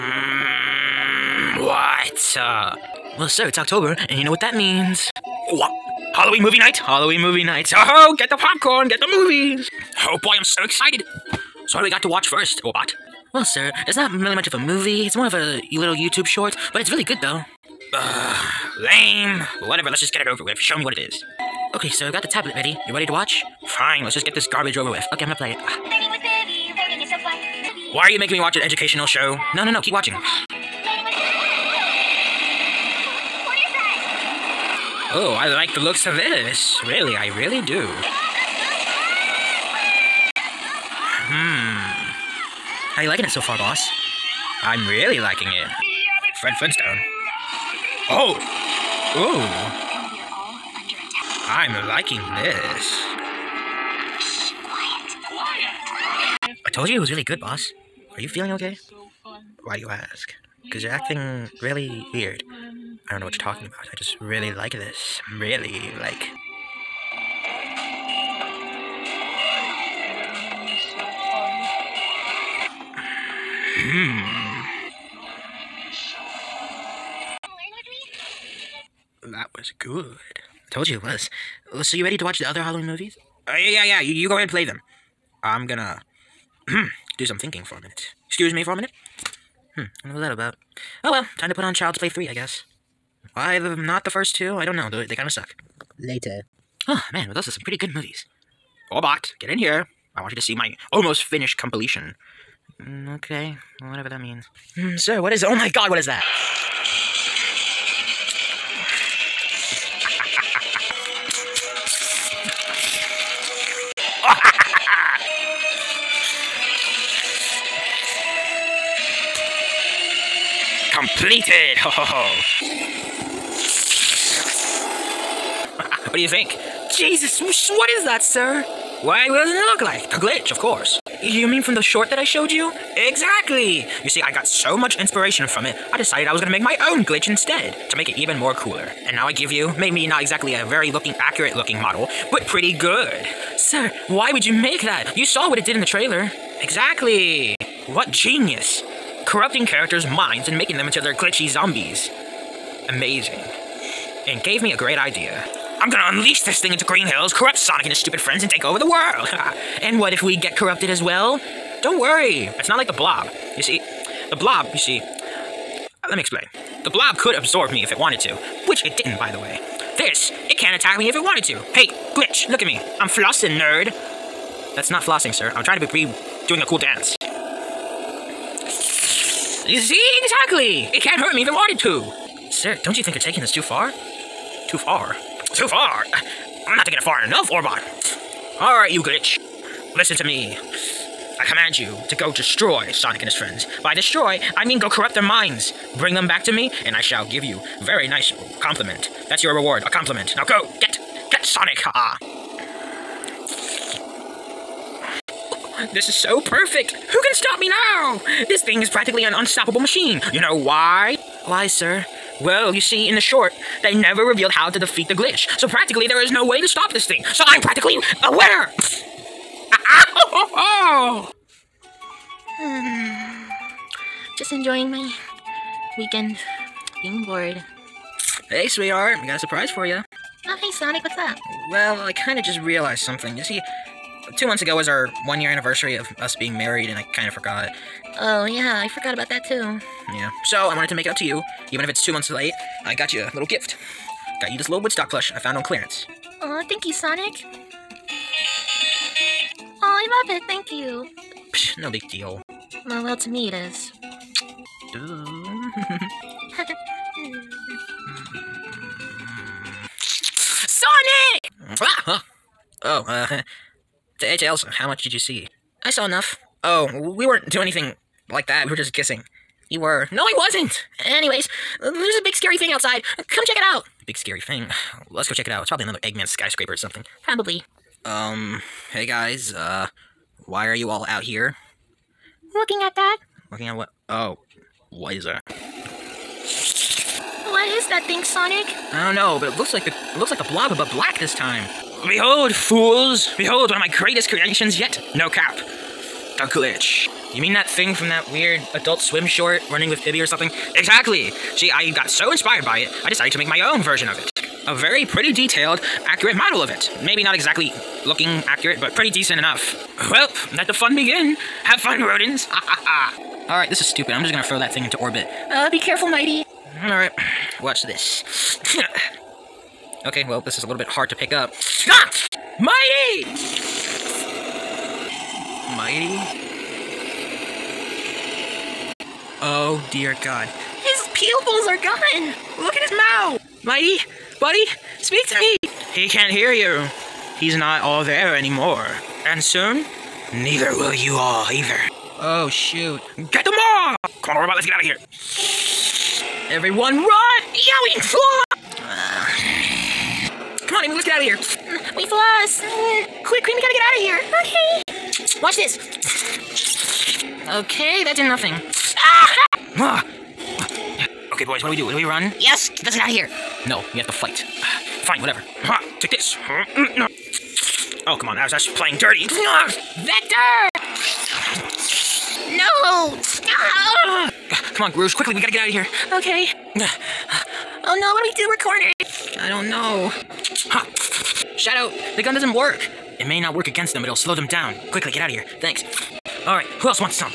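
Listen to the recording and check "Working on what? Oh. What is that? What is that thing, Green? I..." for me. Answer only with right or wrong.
wrong.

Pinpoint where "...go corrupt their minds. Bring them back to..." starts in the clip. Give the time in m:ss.
3:14.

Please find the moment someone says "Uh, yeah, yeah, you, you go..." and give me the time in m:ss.
1:23.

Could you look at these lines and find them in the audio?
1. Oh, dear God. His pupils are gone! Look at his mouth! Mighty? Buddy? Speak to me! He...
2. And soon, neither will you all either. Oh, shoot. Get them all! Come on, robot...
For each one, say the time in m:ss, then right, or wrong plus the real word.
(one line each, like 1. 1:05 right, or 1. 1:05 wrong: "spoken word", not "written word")
1. 5:29 right
2. 5:39 right.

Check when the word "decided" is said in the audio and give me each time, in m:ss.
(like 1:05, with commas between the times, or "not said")
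2:15, 5:03.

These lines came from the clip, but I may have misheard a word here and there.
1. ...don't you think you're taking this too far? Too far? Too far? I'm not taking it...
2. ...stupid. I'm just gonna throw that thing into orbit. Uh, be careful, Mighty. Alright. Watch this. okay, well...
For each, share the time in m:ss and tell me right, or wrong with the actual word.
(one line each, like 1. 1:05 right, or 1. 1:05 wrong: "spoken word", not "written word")
1. 3:02 right
2. 5:13 right.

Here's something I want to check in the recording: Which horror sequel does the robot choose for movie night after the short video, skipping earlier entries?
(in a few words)
Child's Play 3.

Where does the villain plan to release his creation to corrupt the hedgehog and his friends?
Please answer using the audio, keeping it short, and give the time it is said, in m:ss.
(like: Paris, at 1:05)
Green Hills, at 2:36.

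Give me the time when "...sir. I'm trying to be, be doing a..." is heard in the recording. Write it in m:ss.
2:55.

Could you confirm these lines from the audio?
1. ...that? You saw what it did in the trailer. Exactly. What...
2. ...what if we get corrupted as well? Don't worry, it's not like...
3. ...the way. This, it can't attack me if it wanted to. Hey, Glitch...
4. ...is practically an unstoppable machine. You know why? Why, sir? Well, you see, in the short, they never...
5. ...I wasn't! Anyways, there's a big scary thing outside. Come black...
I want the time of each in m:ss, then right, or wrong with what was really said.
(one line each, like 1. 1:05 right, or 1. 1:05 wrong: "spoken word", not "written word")
1. 2:24 right
2. 2:39 right
3. 2:49 right
4. 3:28 right
5. 4:30 wrong: "check", not "black".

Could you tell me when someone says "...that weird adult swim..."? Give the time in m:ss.
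4:58.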